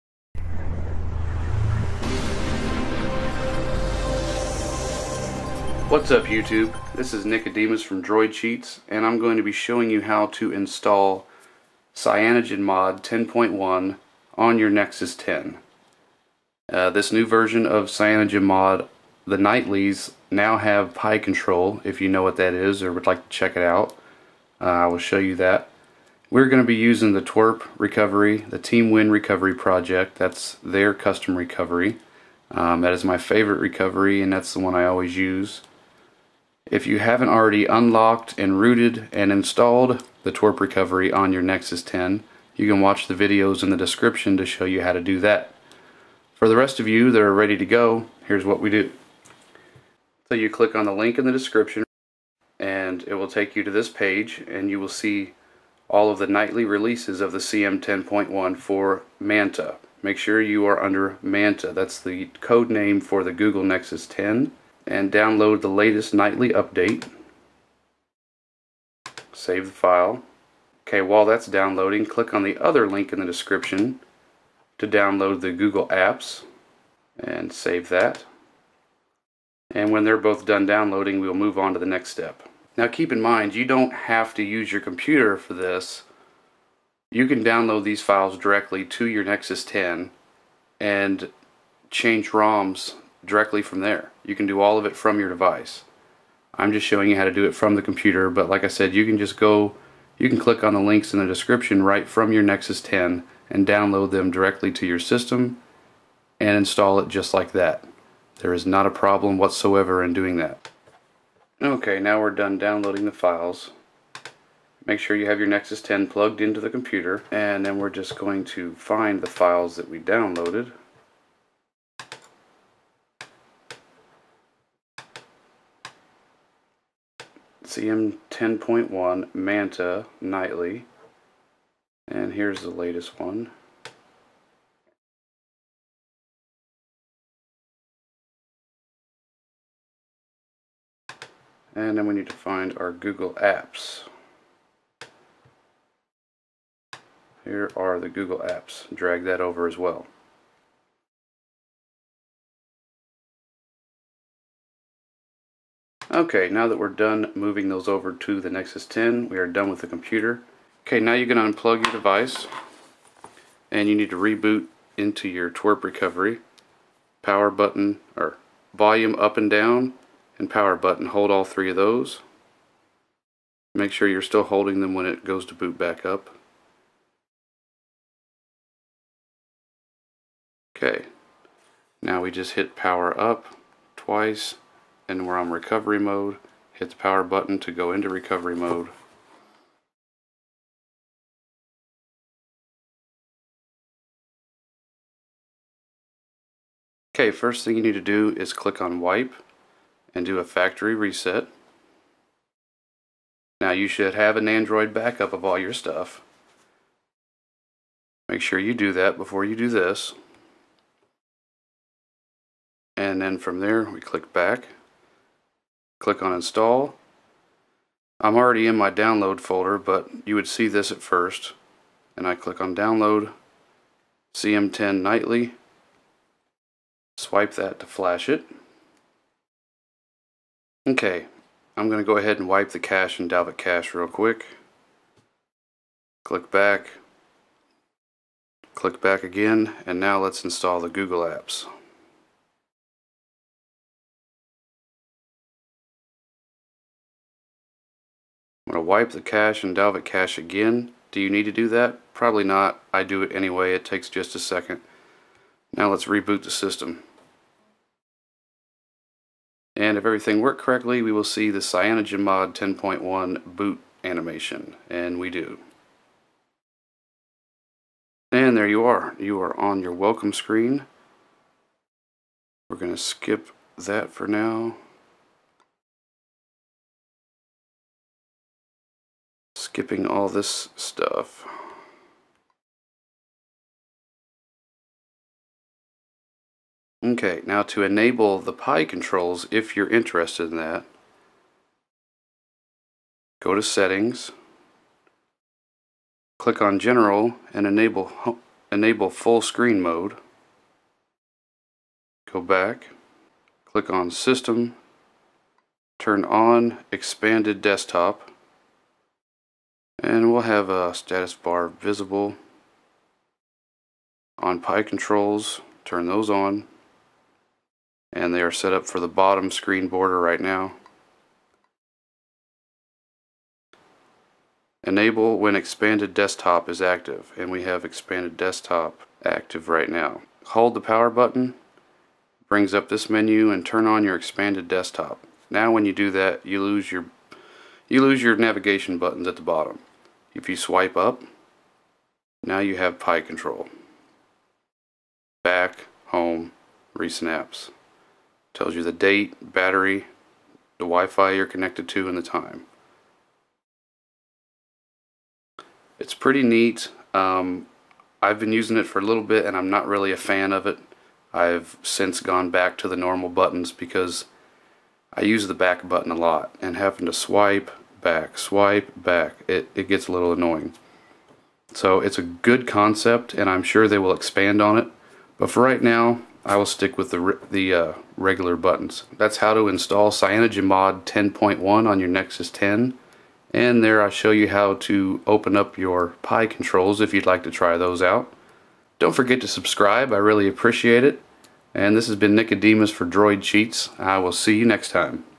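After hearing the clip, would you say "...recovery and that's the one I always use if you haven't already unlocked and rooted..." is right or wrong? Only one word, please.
right.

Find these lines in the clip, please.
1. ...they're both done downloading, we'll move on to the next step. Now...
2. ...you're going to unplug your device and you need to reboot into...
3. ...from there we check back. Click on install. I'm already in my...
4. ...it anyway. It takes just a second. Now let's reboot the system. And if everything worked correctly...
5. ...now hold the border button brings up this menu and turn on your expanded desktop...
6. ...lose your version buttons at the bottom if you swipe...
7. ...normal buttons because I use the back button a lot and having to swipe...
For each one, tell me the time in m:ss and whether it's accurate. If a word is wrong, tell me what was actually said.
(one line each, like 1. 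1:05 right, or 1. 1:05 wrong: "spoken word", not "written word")
1. 1:20 right
2. 2:41 right
3. 3:33 wrong: "click", not "check"
4. 4:13 right
5. 5:29 wrong: "power", not "border"
6. 5:38 wrong: "navigation", not "version"
7. 6:02 right.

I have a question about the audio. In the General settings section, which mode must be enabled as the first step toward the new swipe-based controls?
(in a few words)
Full Screen Mode.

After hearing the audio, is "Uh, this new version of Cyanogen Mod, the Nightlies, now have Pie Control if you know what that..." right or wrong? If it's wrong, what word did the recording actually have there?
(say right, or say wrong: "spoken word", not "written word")
right.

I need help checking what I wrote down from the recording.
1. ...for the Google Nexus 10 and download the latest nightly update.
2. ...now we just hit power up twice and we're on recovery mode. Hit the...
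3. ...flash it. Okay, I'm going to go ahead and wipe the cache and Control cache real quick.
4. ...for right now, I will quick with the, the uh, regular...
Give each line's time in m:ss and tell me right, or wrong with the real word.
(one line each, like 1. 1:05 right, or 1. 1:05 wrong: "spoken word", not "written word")
1. 1:03 right
2. 3:02 right
3. 3:47 wrong: "Dalvik", not "Control"
4. 6:15 wrong: "stick", not "quick".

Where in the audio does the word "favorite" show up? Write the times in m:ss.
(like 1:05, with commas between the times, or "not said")
0:33.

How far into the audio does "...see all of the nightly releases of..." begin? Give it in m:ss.
0:54.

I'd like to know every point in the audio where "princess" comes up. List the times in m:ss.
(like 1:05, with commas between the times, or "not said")
not said.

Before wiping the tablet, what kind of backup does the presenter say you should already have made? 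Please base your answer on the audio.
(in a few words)
Nandroid backup.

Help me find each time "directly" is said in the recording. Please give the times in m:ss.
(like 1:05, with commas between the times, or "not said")
1:28, 1:33, 1:44.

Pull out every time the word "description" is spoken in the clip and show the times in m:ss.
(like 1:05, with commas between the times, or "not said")
0:43, 0:51, 1:13, 1:41.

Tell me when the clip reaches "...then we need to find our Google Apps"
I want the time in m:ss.
2:21.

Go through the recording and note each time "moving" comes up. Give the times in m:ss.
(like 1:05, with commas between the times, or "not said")
2:37.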